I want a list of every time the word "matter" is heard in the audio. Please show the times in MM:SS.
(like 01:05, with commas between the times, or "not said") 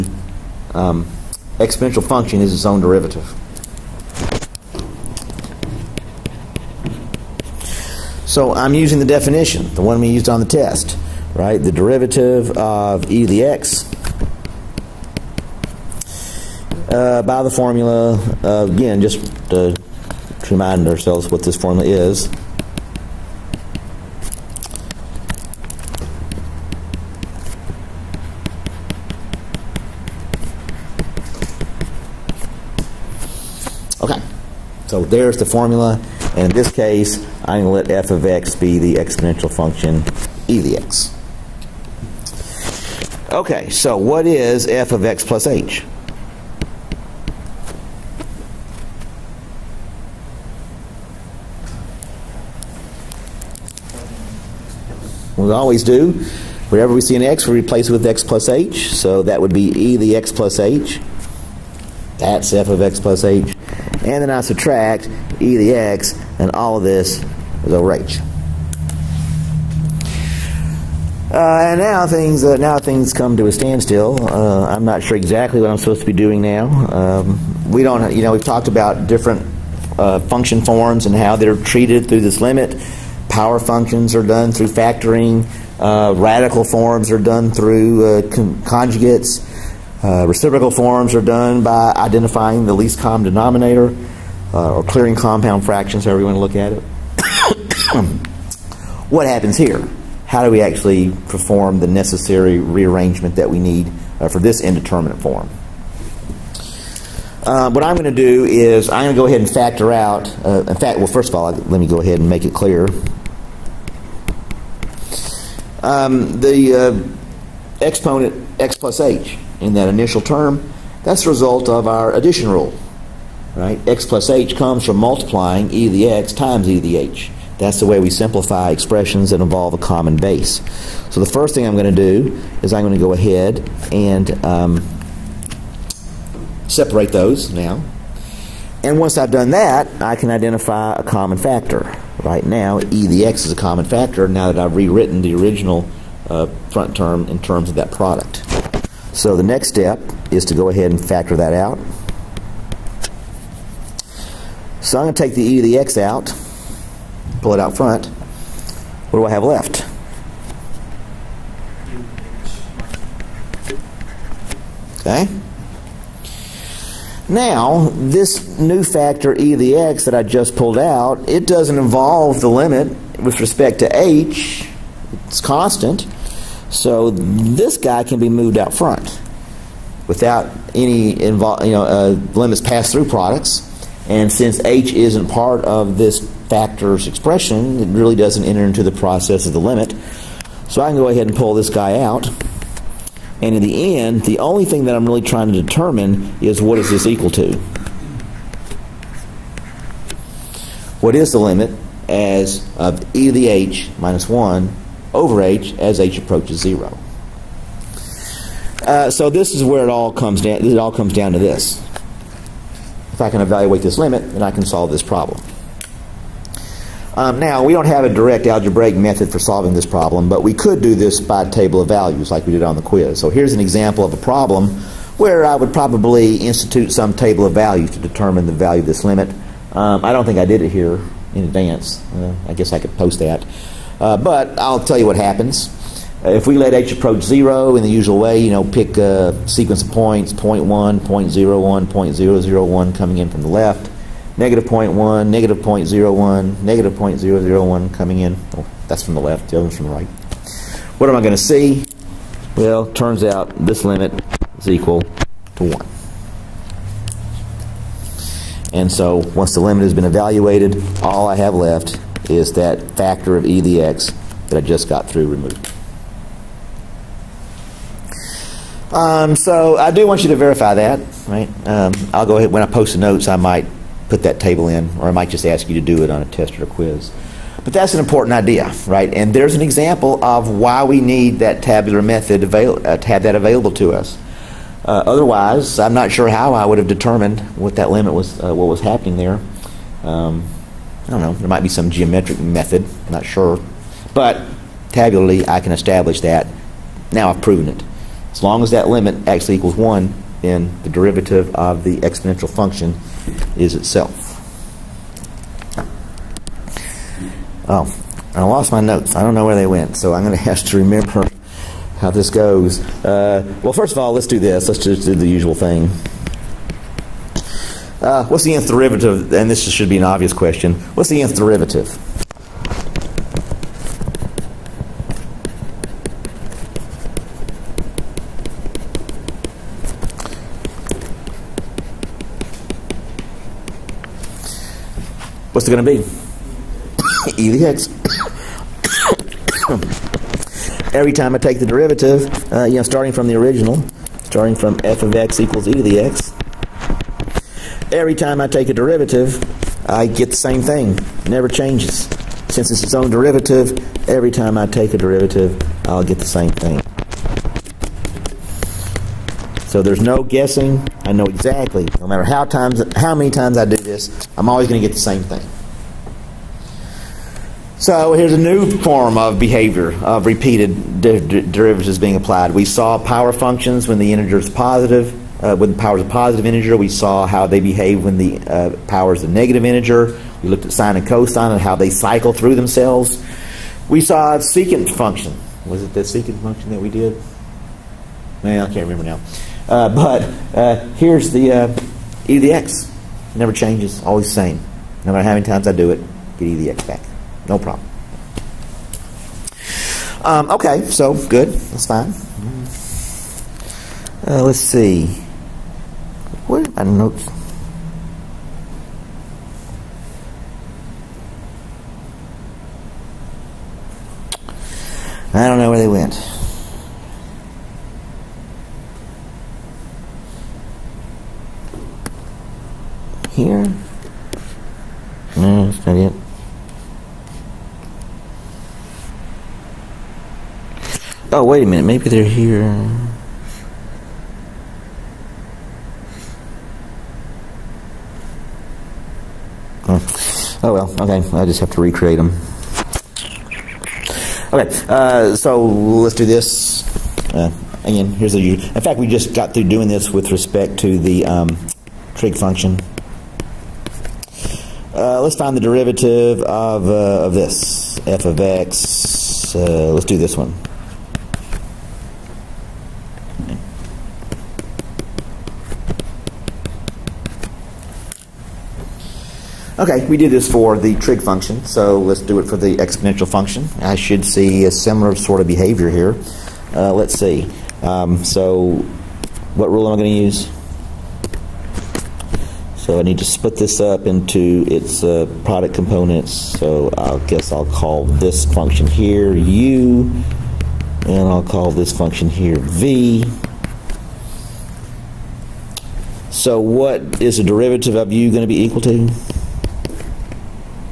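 06:02, 06:35.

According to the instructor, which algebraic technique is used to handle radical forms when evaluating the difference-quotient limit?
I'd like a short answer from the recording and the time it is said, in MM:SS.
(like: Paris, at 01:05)
conjugates, at 01:28.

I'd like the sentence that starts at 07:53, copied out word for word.
I should see a similar sort of behavior here.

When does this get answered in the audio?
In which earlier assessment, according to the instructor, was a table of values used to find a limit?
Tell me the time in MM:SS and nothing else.
03:42.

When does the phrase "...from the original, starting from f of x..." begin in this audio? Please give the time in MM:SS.
05:43.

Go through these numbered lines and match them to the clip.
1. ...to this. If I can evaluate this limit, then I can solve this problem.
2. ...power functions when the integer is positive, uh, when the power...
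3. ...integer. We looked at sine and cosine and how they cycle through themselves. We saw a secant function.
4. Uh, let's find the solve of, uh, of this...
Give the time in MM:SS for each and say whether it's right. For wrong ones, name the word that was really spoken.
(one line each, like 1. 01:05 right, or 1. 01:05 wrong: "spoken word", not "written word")
1. 03:31 right
2. 06:13 right
3. 06:19 right
4. 07:35 wrong: "derivative", not "solve".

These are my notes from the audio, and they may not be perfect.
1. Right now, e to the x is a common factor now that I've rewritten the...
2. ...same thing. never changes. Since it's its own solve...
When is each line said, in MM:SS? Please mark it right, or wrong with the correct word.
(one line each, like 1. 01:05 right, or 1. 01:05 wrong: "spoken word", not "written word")
1. 02:22 right
2. 05:50 wrong: "derivative", not "solve".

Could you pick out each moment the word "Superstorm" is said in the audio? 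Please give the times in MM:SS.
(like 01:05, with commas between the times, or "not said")
not said.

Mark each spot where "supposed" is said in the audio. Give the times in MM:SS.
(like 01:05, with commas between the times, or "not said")
01:15.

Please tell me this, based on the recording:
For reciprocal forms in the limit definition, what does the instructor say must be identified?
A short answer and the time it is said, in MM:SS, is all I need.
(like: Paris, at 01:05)
least common denominator, at 01:32.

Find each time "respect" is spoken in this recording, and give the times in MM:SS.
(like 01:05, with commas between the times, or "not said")
02:53, 07:30.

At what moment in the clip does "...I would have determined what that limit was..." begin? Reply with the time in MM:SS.
04:46.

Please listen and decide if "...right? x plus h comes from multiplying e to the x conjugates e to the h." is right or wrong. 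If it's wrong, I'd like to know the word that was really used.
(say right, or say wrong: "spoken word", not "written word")
wrong: "times", not "conjugates".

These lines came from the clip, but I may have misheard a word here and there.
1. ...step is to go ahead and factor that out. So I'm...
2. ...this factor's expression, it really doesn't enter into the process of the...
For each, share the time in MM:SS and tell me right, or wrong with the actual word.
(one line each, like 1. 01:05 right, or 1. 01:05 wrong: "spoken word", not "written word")
1. 02:29 right
2. 03:05 right.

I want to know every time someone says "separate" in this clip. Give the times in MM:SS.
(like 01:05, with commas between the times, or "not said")
02:16.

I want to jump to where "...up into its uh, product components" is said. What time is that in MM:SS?
08:03.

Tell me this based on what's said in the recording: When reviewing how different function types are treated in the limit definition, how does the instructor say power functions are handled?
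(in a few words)
factoring.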